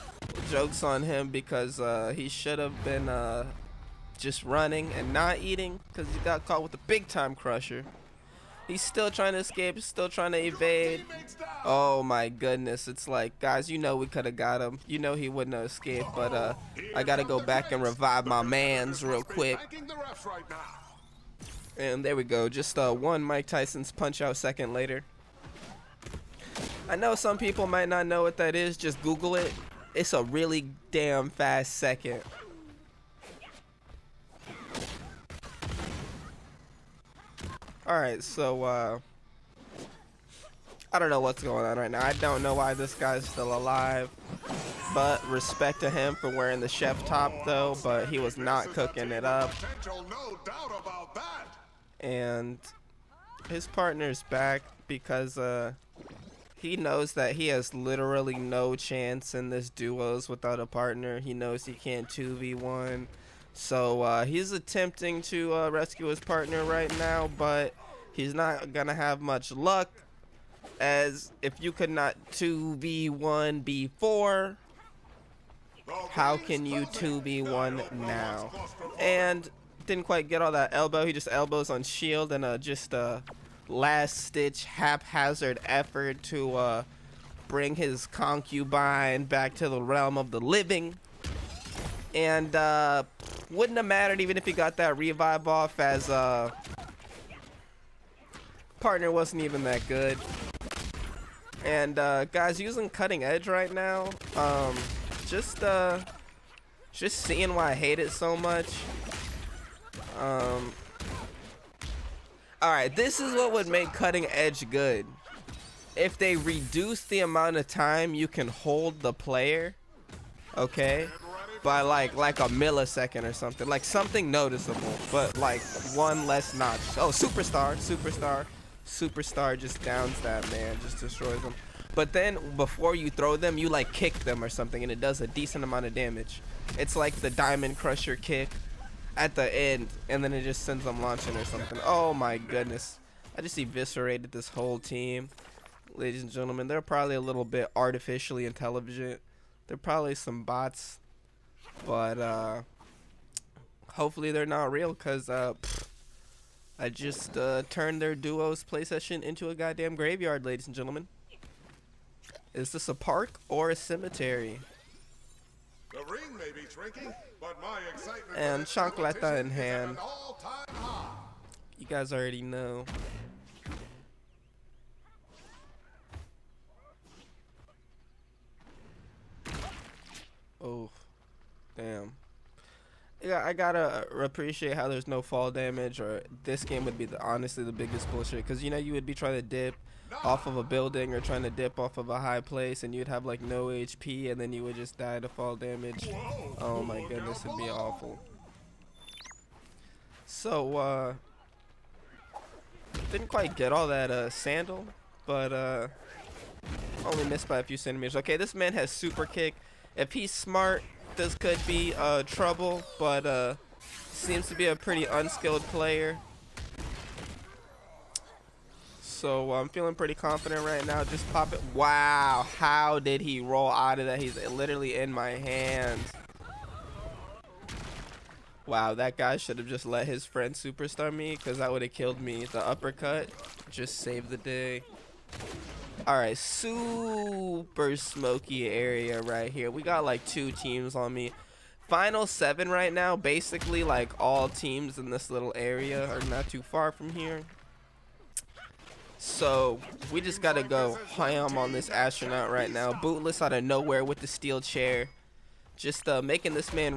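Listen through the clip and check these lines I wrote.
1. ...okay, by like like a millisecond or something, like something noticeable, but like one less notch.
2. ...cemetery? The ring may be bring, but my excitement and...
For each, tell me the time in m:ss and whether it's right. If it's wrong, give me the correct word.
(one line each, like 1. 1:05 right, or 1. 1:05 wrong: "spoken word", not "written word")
1. 2:00 right
2. 2:43 wrong: "shrinking", not "bring".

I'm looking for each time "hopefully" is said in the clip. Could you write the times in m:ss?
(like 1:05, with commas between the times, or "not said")
2:33.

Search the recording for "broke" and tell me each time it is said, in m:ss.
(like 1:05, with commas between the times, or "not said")
not said.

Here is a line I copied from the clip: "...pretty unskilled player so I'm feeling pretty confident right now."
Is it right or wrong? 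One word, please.
right.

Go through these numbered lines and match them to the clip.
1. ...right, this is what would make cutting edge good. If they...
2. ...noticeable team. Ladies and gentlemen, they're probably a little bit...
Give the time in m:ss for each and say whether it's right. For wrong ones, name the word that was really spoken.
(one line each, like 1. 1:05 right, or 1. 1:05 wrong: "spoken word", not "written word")
1. 1:52 right
2. 2:24 wrong: "whole", not "noticeable".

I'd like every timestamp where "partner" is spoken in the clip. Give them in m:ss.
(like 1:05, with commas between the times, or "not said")
0:53, 1:00, 1:06, 1:38.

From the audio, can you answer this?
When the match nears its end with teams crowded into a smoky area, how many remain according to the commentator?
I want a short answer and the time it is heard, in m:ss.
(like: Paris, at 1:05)
Final 7, at 4:01.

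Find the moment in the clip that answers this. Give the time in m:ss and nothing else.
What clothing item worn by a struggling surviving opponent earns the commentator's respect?
0:46.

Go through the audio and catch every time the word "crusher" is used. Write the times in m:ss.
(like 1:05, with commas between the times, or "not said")
0:07, 2:17.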